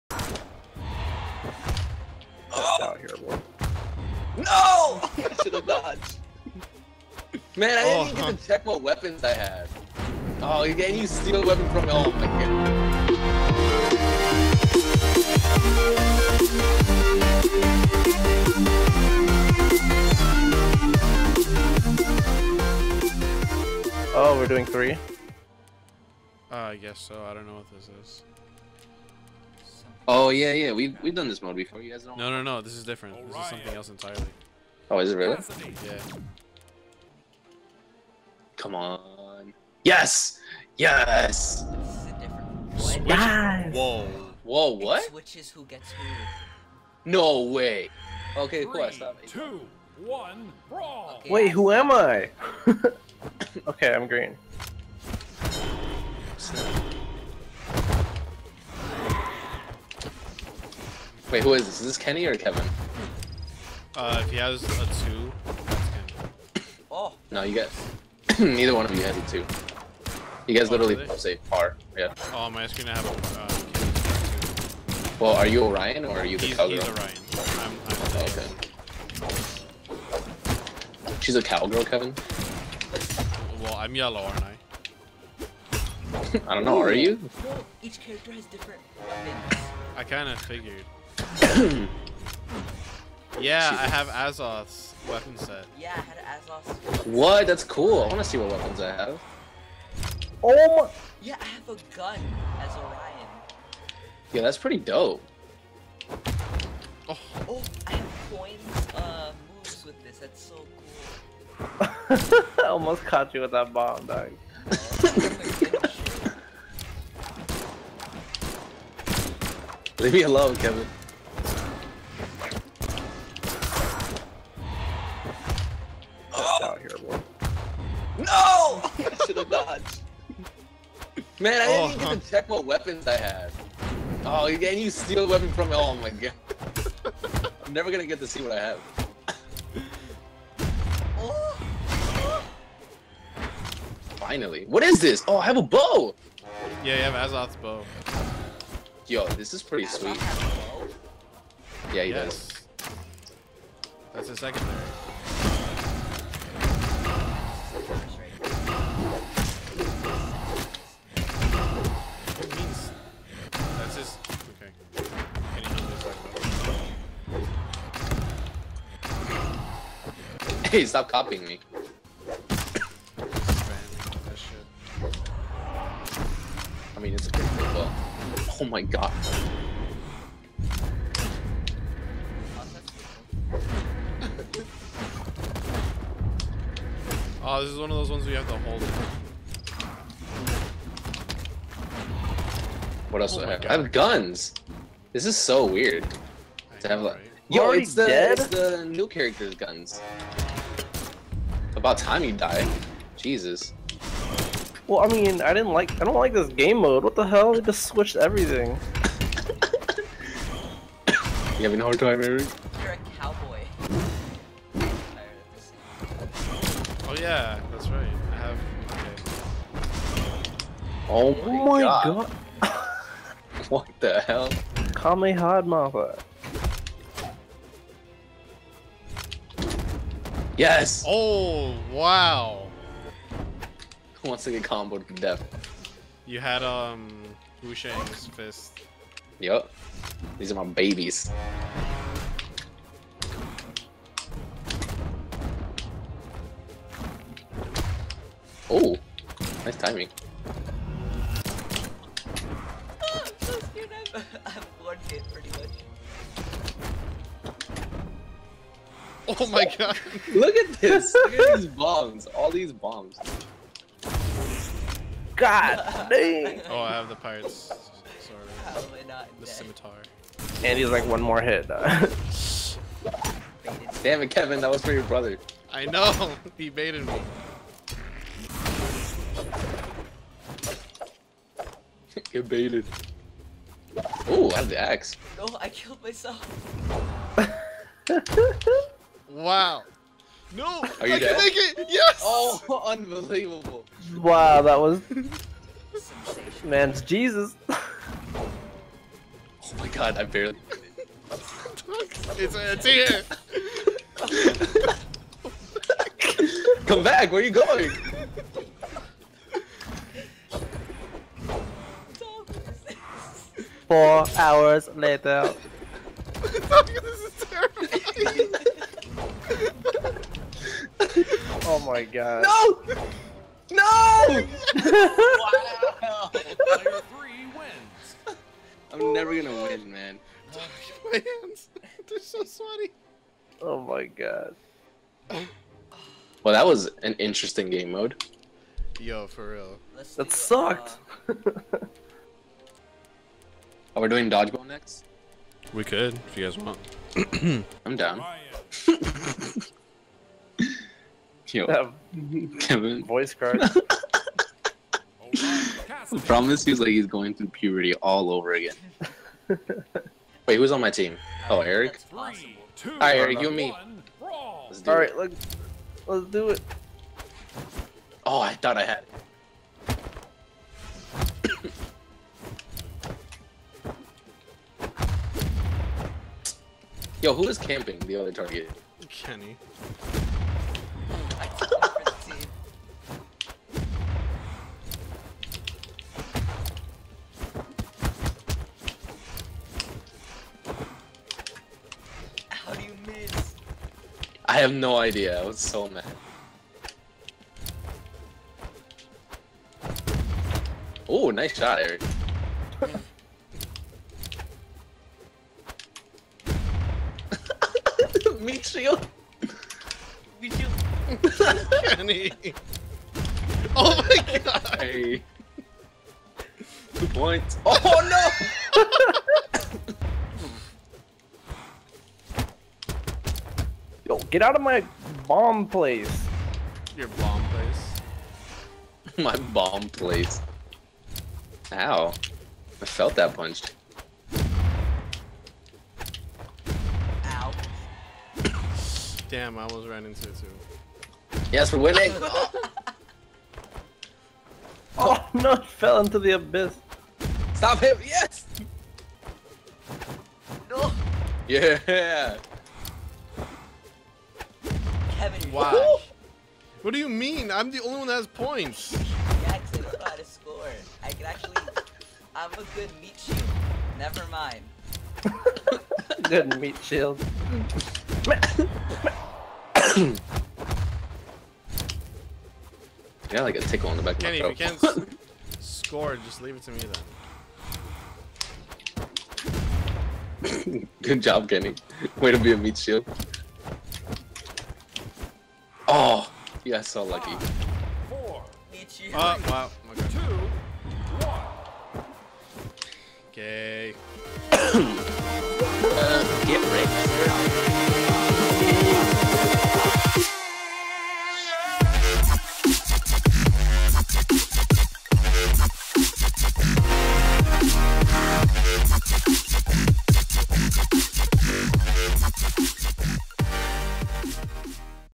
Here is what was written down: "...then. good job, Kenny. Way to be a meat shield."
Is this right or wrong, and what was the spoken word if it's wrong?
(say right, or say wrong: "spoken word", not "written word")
right.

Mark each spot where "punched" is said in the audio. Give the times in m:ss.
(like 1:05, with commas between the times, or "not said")
7:13.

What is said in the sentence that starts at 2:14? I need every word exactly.
Oh, and you steal a weapon from me.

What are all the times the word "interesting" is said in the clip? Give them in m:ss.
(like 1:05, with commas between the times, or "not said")
5:37.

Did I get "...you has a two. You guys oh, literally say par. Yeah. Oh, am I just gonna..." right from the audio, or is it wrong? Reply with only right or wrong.
right.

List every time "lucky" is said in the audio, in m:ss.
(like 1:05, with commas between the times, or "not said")
8:07.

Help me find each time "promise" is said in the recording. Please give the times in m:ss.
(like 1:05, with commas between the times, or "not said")
5:56.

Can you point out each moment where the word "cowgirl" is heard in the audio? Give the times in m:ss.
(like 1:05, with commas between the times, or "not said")
1:16, 1:21.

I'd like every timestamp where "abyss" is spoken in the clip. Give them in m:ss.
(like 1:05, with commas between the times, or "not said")
7:26.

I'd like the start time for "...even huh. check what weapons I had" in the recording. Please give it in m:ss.
0:08.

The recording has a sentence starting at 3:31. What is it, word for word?
you having a hard time, Eric?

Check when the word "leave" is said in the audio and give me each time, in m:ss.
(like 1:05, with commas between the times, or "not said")
1:59, 7:56.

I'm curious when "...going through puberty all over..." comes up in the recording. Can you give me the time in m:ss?
5:57.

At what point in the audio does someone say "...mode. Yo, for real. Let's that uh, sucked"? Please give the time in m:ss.
5:37.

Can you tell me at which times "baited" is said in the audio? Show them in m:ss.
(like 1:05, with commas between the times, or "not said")
4:36, 4:42.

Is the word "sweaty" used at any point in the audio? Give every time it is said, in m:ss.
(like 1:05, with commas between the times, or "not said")
5:32.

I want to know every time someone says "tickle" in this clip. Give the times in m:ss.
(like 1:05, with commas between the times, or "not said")
7:53.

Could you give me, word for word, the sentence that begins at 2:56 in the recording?
I mean, it's a good thing, but...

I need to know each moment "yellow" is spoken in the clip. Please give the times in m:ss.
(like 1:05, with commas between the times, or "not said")
1:23.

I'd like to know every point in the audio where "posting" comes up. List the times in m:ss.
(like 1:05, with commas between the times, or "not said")
not said.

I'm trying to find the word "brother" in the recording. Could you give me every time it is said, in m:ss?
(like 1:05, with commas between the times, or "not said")
4:35.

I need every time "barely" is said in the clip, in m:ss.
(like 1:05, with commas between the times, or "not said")
5:00.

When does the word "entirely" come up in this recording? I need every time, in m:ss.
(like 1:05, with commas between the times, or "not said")
0:33.